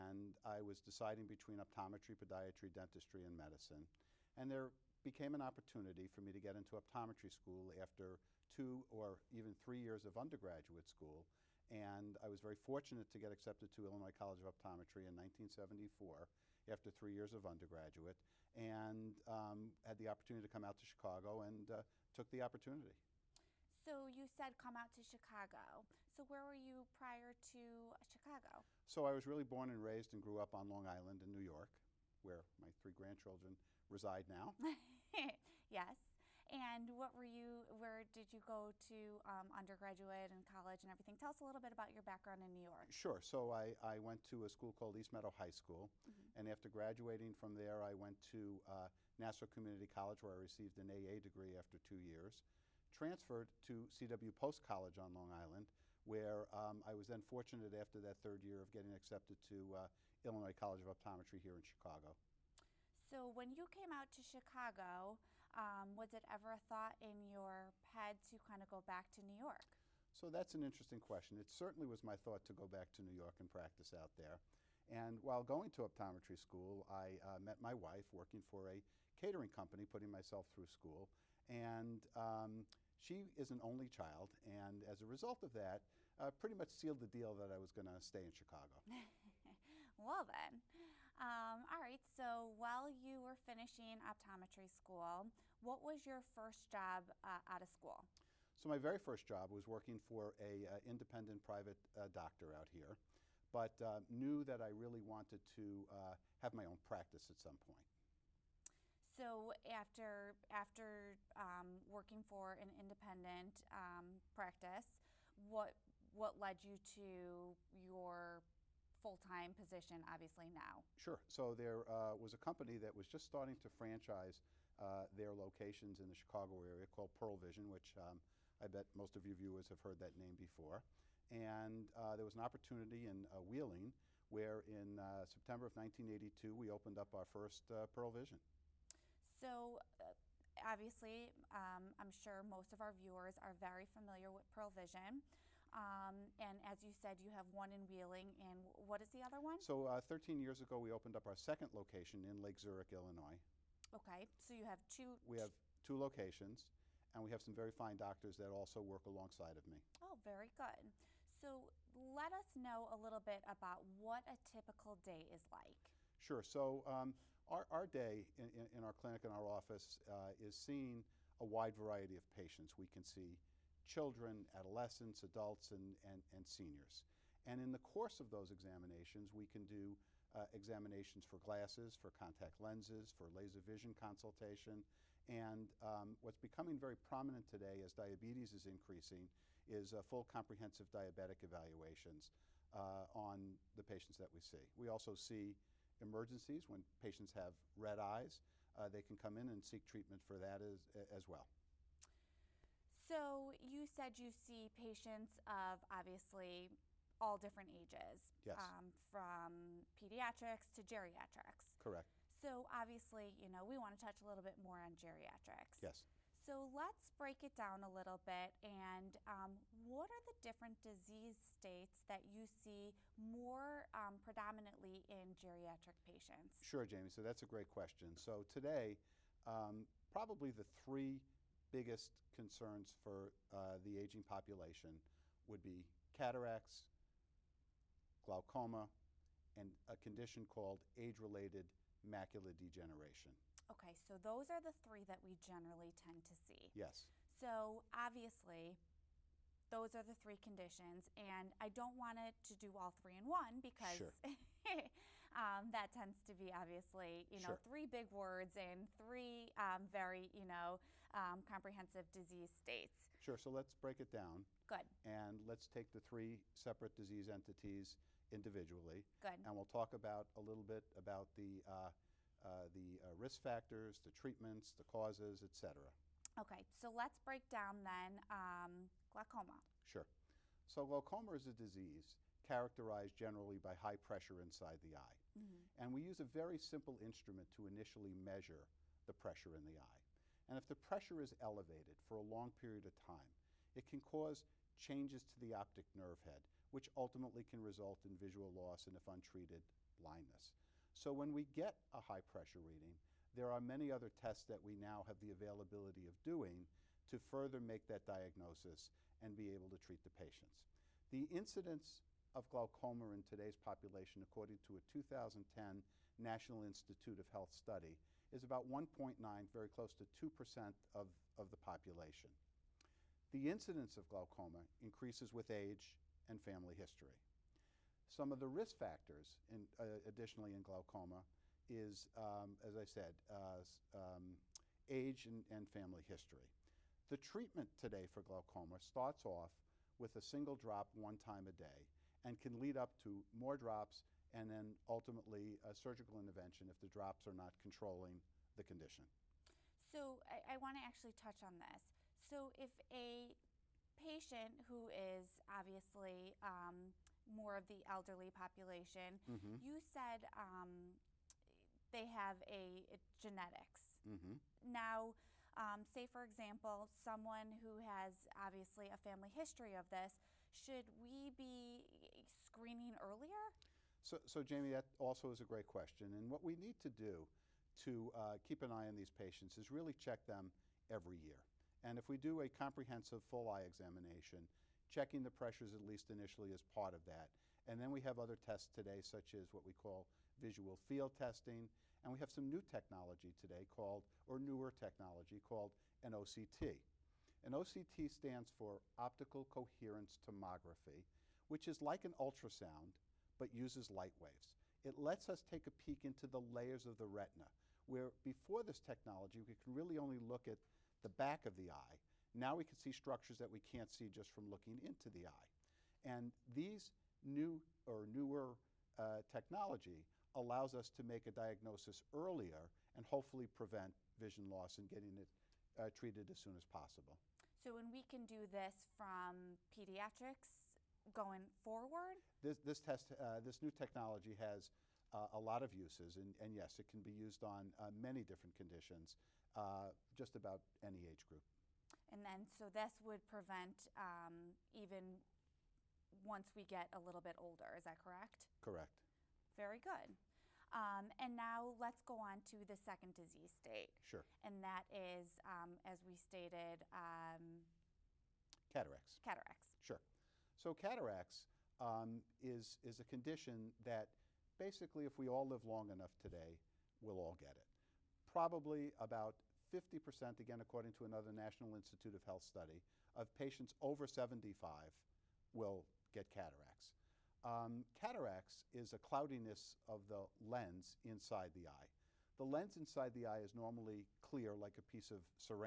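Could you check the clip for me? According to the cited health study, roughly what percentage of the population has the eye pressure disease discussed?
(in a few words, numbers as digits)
1.9%.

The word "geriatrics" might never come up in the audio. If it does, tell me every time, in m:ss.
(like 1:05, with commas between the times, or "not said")
3:30, 3:34, 3:45.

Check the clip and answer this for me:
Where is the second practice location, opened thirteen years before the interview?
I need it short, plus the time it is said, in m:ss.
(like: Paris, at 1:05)
Lake Zurich, Illinois, at 2:32.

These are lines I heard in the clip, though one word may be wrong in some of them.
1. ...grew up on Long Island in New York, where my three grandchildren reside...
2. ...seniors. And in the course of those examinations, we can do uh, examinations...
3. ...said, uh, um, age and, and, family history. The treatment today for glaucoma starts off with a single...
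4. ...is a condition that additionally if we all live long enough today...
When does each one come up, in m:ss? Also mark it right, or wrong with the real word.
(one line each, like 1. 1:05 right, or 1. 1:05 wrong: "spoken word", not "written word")
1. 0:30 right
2. 2:56 right
3. 5:32 right
4. 7:42 wrong: "basically", not "additionally".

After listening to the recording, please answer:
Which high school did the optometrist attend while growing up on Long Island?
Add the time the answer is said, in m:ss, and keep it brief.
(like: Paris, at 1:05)
East Meadow High School, at 0:44.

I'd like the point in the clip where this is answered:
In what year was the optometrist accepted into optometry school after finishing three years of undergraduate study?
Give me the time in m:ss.
0:15.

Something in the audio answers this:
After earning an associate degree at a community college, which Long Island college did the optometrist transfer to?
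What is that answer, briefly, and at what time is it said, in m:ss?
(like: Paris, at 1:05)
CW Post College, at 0:53.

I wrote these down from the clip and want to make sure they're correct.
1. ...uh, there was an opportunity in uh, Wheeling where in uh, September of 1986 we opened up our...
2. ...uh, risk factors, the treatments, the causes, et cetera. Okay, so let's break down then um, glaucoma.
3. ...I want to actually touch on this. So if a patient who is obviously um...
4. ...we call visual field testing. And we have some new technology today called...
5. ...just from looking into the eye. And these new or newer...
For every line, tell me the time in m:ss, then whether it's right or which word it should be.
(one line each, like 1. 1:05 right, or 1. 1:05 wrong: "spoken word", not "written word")
1. 2:11 wrong: "1982", not "1986"
2. 4:33 right
3. 5:50 right
4. 6:29 right
5. 6:54 right.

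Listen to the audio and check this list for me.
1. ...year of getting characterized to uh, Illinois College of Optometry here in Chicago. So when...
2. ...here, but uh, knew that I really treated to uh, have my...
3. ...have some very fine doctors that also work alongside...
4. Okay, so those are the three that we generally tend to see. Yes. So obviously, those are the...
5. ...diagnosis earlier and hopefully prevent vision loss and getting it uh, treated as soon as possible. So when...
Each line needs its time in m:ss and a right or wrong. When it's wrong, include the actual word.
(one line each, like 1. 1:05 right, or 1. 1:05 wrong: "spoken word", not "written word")
1. 0:58 wrong: "accepted", not "characterized"
2. 1:42 wrong: "wanted", not "treated"
3. 2:37 right
4. 4:03 right
5. 7:01 right.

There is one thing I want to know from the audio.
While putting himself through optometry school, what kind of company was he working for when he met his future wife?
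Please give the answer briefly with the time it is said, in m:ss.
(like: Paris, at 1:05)
A catering company, at 1:19.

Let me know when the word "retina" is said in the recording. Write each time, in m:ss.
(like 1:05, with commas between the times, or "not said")
6:47.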